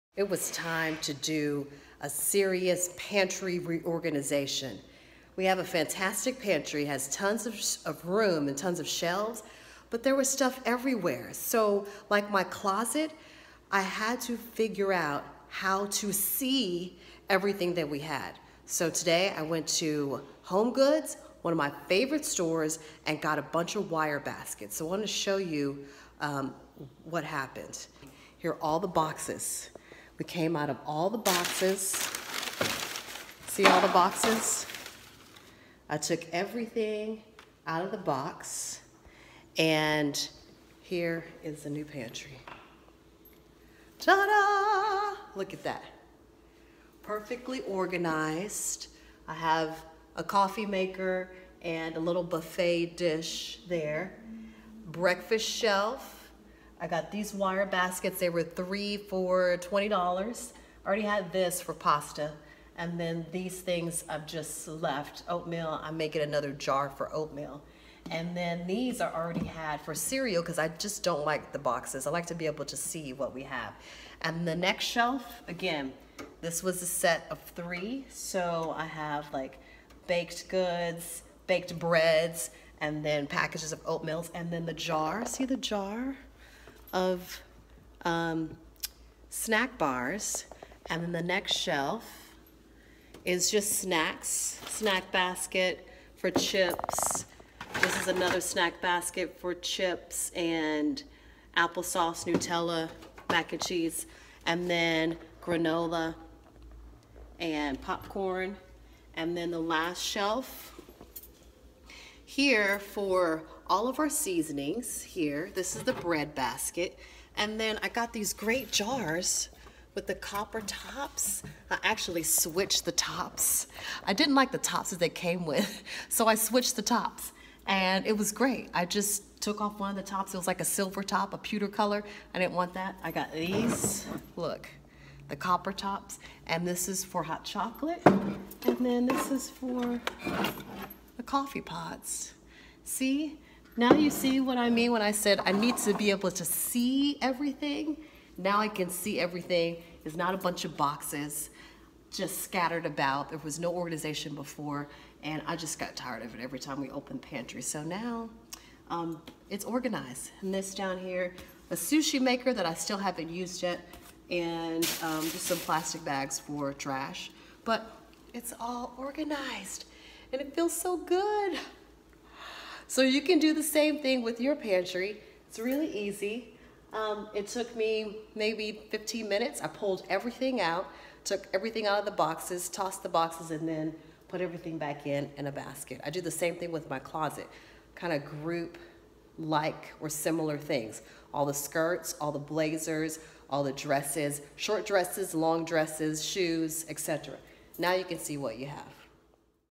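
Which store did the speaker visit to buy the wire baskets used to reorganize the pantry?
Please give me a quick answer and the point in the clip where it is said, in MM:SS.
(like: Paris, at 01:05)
Home Goods, at 00:20.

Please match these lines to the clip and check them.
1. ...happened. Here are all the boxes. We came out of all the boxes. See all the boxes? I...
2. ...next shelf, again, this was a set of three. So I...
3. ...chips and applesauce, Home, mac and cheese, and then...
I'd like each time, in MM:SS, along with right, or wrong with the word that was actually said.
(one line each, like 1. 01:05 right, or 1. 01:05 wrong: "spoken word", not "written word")
1. 00:27 right
2. 01:14 right
3. 01:39 wrong: "Nutella", not "Home".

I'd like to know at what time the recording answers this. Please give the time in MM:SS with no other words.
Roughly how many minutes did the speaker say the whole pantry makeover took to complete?
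02:58.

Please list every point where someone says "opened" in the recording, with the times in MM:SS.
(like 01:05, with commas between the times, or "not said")
02:36.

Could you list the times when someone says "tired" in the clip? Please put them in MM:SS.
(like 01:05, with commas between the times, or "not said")
02:35.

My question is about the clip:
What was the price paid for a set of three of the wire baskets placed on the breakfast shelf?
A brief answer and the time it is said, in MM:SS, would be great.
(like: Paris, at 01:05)
$20, at 00:59.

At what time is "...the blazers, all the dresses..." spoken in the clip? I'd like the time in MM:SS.
03:12.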